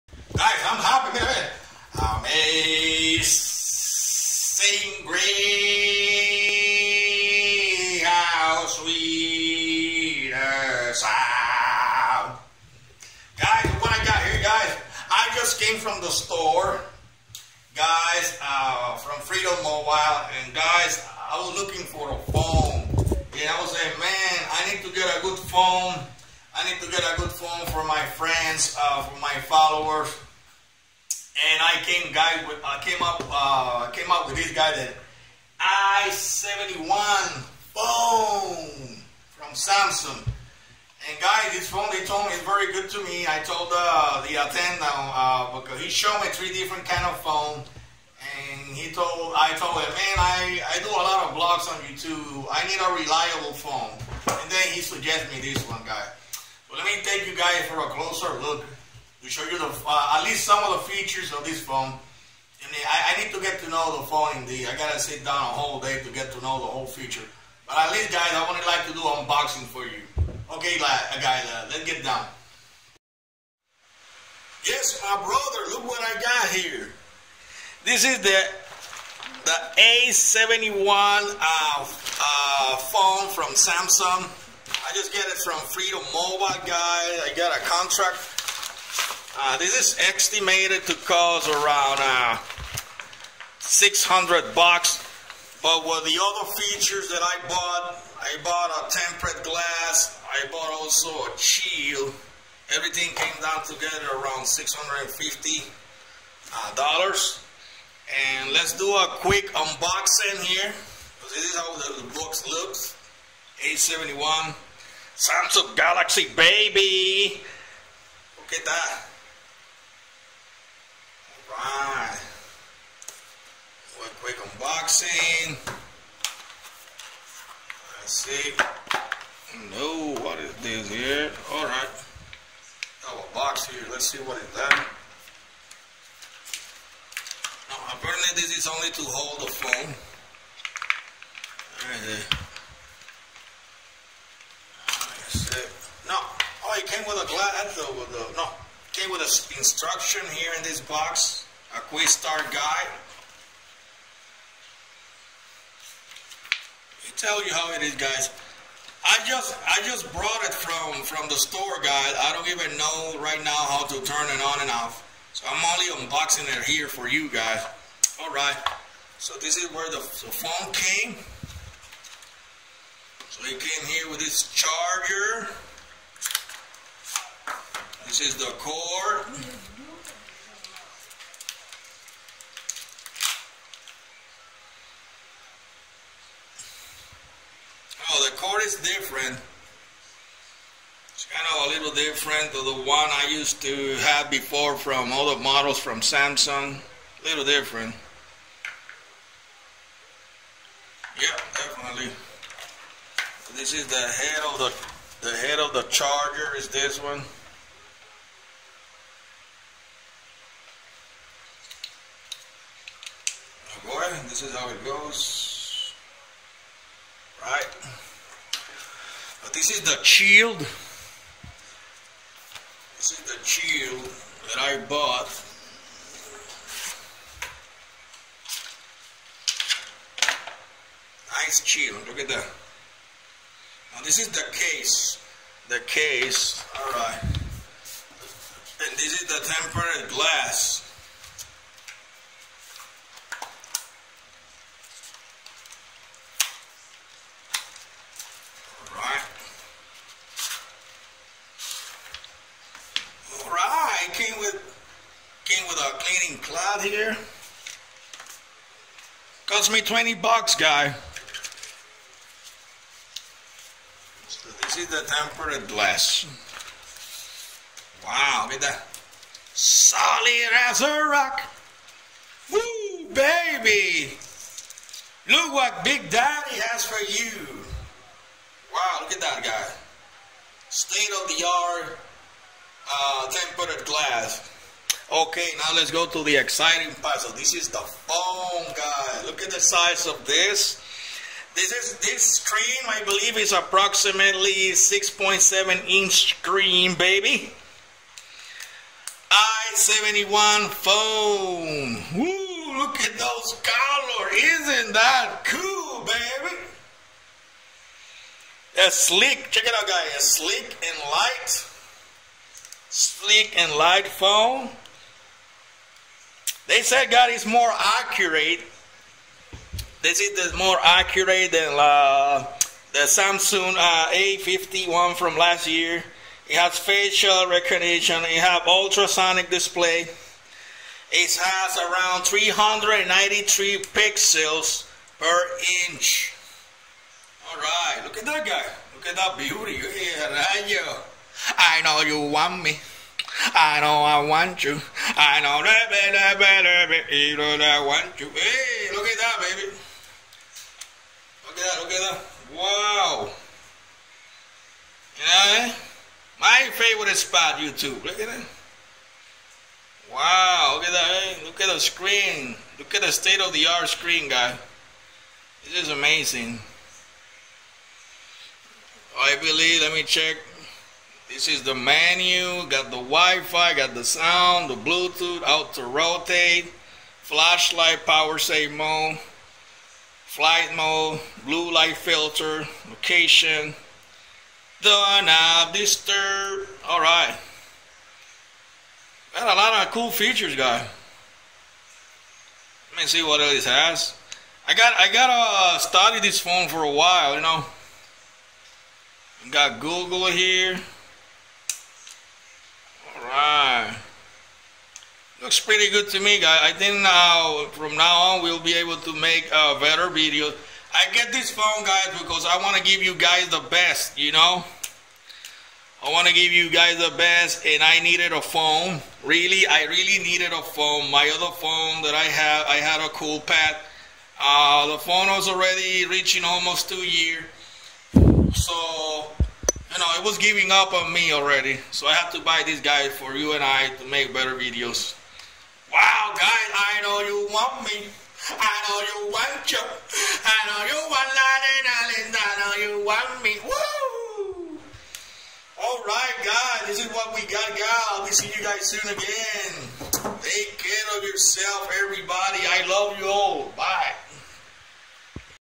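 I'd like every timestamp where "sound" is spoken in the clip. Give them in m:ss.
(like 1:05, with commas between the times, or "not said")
0:10, 6:14.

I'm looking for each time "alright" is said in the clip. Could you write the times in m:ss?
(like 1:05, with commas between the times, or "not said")
2:01, 2:11, 3:56.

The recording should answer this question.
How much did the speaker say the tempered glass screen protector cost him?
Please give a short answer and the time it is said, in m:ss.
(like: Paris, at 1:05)
20 bucks, at 4:19.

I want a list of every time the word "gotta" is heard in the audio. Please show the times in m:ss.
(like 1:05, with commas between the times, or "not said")
1:04, 6:35.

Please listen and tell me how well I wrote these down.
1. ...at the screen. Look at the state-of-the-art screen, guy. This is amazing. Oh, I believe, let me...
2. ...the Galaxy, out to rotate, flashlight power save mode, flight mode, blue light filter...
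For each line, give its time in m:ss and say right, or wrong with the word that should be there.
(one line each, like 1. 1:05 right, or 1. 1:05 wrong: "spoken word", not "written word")
1. 6:01 right
2. 6:14 wrong: "Bluetooth", not "Galaxy".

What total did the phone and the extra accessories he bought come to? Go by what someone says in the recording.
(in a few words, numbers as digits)
650 dollars.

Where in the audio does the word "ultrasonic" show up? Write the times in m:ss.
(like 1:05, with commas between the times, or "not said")
5:28.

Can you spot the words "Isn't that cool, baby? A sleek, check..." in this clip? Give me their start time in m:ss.
5:04.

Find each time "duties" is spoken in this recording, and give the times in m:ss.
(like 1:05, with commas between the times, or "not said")
not said.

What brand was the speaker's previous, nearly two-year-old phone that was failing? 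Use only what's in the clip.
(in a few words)
Coolpad.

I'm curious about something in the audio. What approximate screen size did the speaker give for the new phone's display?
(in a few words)
6.7 inch.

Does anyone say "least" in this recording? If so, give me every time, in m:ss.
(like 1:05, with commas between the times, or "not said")
1:00, 1:07.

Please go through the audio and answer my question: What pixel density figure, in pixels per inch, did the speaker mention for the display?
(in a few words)
393.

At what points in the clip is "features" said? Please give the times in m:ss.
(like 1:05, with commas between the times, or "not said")
1:00, 1:06, 1:36, 6:30.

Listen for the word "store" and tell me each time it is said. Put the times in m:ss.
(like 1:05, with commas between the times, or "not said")
0:16, 2:41.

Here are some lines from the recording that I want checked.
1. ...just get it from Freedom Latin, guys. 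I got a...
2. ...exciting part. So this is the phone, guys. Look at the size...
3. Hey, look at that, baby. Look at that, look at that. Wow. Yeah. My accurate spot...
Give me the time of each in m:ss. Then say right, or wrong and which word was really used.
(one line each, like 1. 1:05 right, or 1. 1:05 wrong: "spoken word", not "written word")
1. 1:24 wrong: "Mobile", not "Latin"
2. 4:46 right
3. 5:48 wrong: "favorite", not "accurate".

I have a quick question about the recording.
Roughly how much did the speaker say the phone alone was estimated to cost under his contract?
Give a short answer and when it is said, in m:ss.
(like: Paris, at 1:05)
600 bucks, at 1:33.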